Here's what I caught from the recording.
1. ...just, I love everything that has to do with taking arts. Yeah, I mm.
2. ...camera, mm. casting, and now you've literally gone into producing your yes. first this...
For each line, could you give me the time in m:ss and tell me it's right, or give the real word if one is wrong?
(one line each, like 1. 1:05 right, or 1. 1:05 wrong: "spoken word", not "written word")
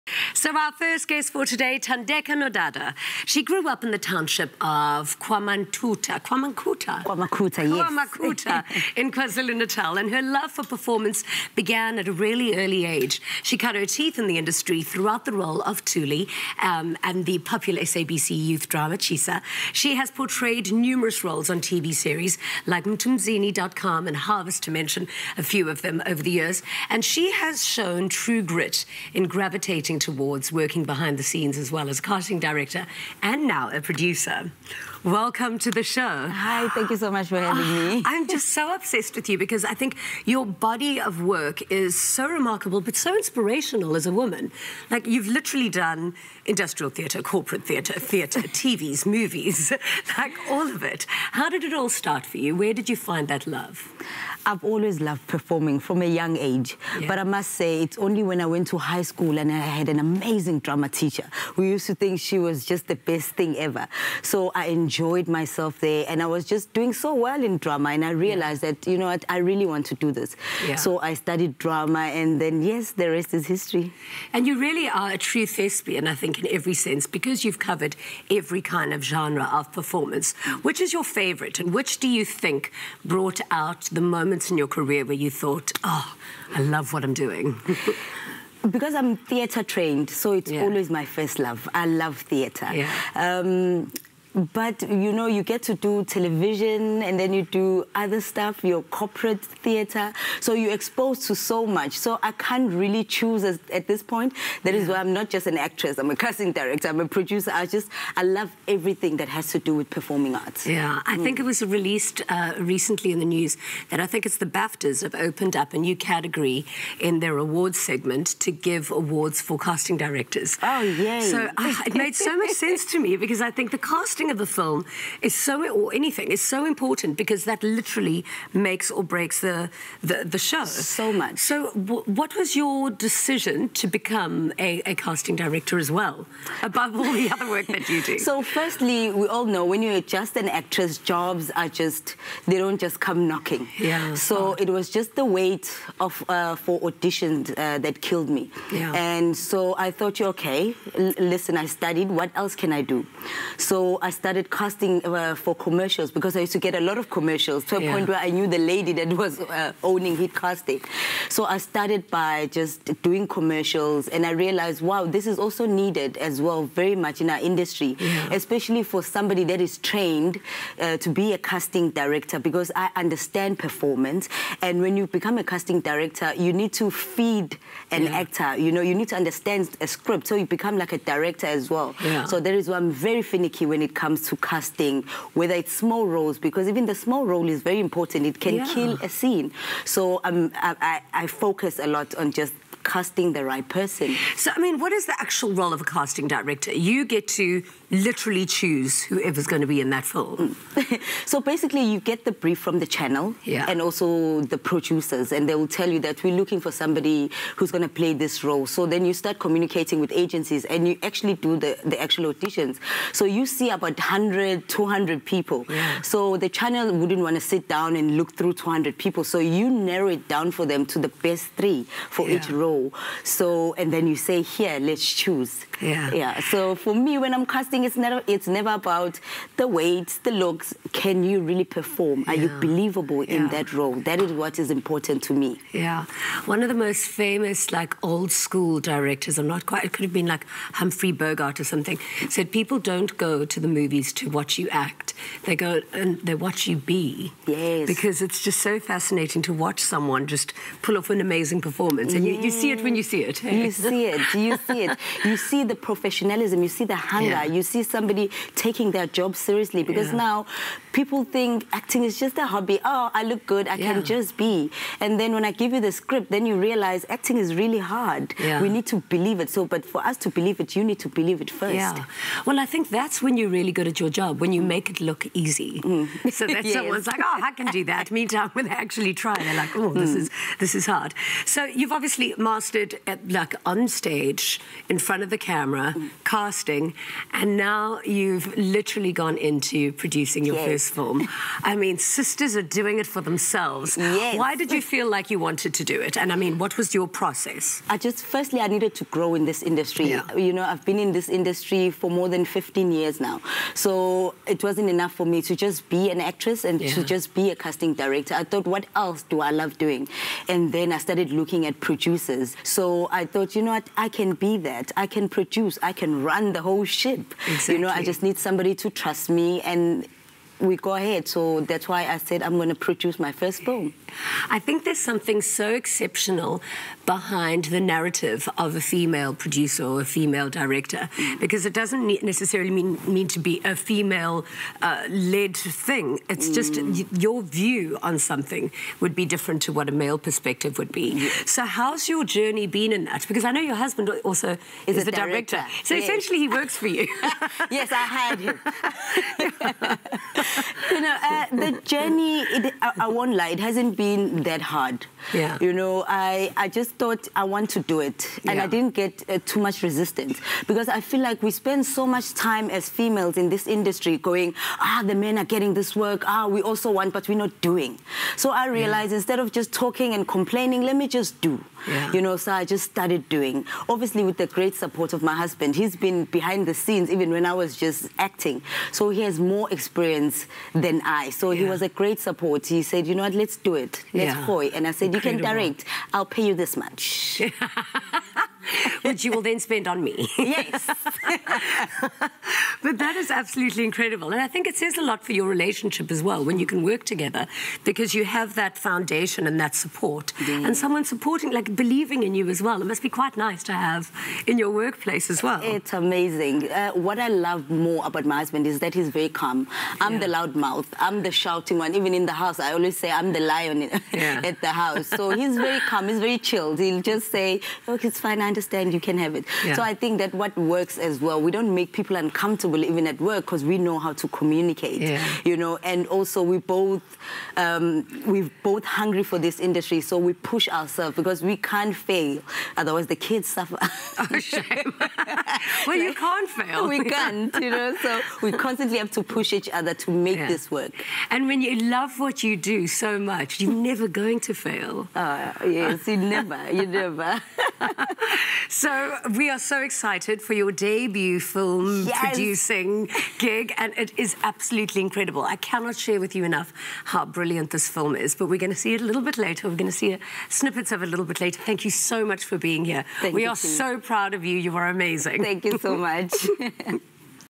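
1. 1:47 wrong: "performing", not "taking"
2. 4:45 right.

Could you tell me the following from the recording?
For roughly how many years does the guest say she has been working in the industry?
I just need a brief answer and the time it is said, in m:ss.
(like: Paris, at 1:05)
15, at 5:02.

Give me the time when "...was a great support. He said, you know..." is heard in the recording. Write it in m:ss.
6:21.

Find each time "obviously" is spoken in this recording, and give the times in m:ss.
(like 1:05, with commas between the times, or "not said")
4:41, 6:13.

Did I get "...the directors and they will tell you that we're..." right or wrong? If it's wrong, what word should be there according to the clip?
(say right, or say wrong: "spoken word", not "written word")
wrong: "producers", not "directors".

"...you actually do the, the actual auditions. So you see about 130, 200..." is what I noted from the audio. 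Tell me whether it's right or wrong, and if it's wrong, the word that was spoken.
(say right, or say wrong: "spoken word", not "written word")
wrong: "100", not "130".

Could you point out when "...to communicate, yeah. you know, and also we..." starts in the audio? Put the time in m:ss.
7:04.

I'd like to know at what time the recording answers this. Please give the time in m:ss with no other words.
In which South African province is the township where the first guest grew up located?
0:09.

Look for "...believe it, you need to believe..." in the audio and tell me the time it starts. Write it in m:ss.
4:30.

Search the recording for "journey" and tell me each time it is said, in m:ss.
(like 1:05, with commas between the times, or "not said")
5:42, 5:51.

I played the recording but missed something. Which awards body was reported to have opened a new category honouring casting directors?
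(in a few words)
BAFTAs.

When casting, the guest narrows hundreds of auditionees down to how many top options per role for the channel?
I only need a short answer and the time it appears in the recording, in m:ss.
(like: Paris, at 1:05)
3, at 3:41.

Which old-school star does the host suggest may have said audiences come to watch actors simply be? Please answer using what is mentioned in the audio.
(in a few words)
Humphrey Bogart.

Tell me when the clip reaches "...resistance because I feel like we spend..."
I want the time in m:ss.
5:59.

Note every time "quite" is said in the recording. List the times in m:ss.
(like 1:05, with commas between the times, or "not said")
3:59, 6:43.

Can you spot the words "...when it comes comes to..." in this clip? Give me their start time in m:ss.
3:03.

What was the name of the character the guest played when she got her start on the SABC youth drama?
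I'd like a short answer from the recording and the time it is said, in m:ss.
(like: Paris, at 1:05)
Thuli, at 0:15.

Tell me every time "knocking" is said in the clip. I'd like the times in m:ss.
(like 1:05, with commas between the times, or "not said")
2:23.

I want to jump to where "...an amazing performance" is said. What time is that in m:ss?
4:11.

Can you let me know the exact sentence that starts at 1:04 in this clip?
So I enjoyed enjoyed myself there and I was just doing so well in drama and I realized yeah.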